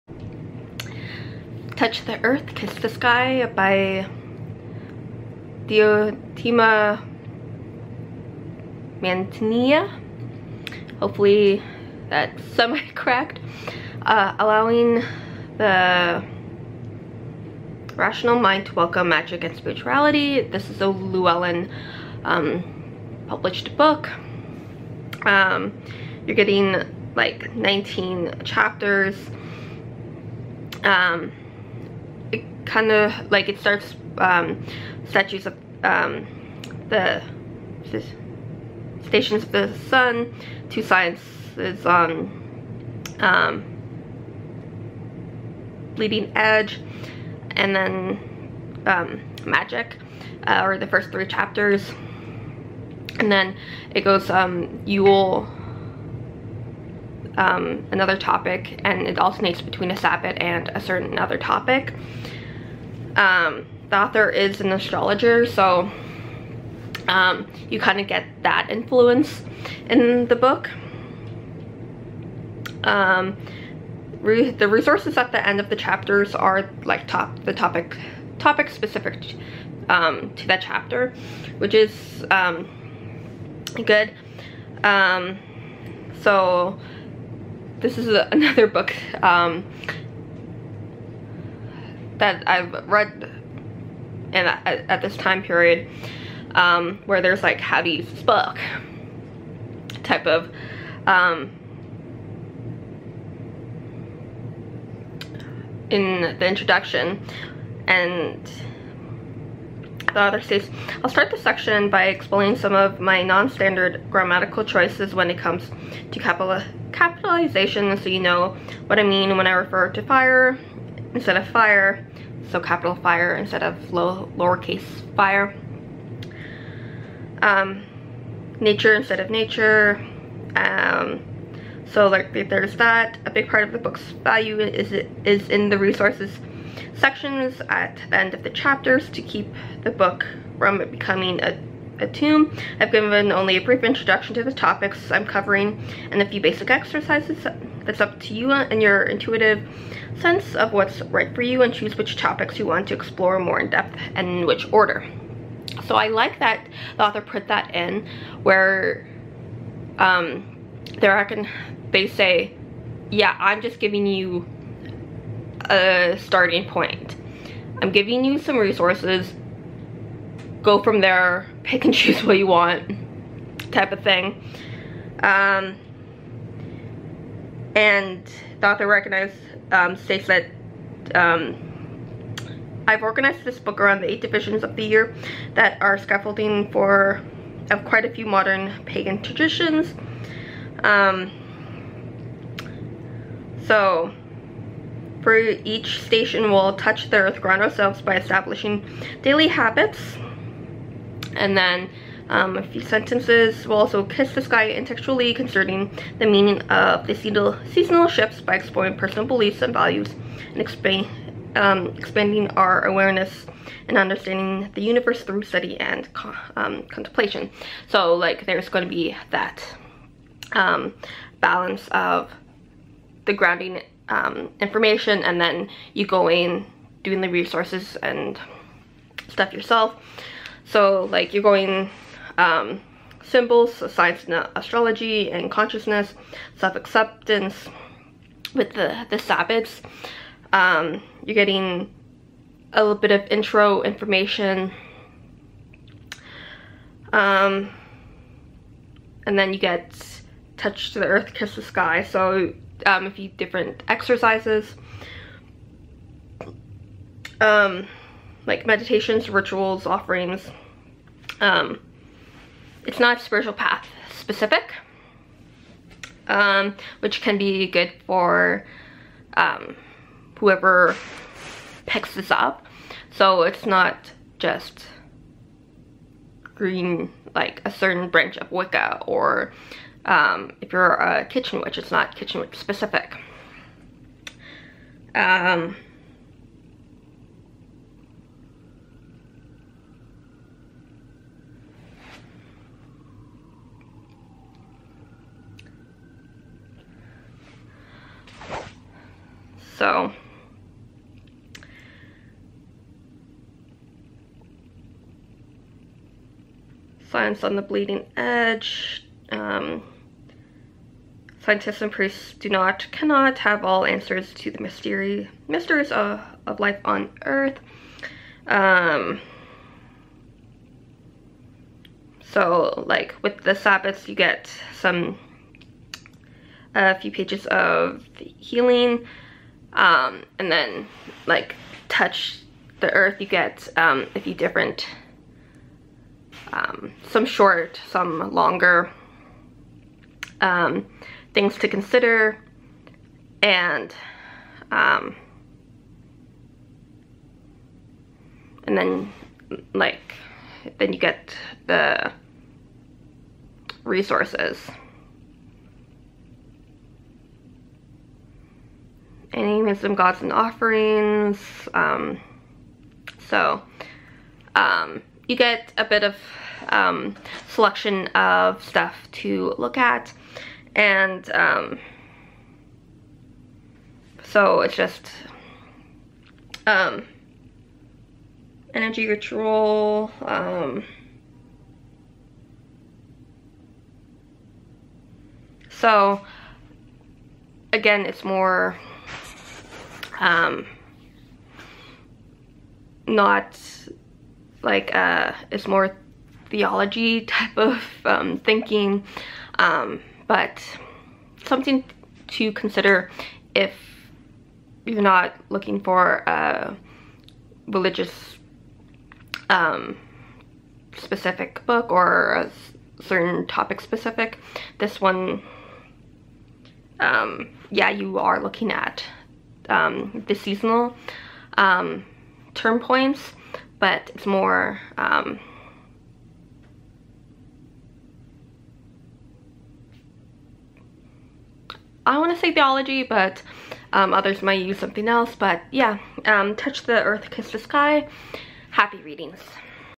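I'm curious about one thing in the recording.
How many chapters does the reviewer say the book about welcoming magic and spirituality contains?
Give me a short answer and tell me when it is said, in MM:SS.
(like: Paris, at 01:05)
19, at 00:27.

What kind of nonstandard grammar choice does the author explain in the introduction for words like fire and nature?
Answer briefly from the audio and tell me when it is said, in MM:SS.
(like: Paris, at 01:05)
Capitalization, at 01:56.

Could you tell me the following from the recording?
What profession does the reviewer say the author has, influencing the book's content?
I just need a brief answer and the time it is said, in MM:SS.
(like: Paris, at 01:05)
Astrologer, at 01:04.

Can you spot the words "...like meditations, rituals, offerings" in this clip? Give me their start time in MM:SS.
04:18.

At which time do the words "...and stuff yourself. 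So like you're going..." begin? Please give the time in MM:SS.
03:47.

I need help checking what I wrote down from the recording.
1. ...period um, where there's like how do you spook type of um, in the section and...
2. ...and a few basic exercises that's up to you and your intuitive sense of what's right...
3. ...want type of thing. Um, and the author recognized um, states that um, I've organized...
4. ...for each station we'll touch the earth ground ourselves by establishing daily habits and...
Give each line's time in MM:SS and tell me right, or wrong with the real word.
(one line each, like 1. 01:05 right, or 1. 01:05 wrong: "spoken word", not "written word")
1. 01:35 wrong: "introduction", not "section"
2. 02:26 right
3. 02:52 right
4. 03:15 right.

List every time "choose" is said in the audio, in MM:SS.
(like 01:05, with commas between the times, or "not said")
02:31, 02:51.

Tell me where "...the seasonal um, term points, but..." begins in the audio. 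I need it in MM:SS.
07:00.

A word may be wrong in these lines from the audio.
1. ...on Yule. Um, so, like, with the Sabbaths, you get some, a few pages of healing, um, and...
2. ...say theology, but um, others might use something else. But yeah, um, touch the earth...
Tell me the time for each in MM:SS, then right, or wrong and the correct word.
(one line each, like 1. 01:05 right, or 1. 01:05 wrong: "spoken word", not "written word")
1. 05:16 wrong: "Earth", not "Yule"
2. 07:12 right.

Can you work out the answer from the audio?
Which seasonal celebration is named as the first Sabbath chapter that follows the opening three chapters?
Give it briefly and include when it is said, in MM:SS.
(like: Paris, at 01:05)
Yule, at 00:54.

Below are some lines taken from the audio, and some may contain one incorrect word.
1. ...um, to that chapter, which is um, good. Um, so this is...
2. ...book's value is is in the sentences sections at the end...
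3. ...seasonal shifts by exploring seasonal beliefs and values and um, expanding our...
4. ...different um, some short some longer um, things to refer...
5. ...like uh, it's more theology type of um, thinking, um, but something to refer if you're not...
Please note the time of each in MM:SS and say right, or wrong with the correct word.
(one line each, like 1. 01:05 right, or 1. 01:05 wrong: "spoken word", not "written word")
1. 01:19 right
2. 02:13 wrong: "resources", not "sentences"
3. 03:27 wrong: "personal", not "seasonal"
4. 05:34 wrong: "consider", not "refer"
5. 06:34 wrong: "consider", not "refer".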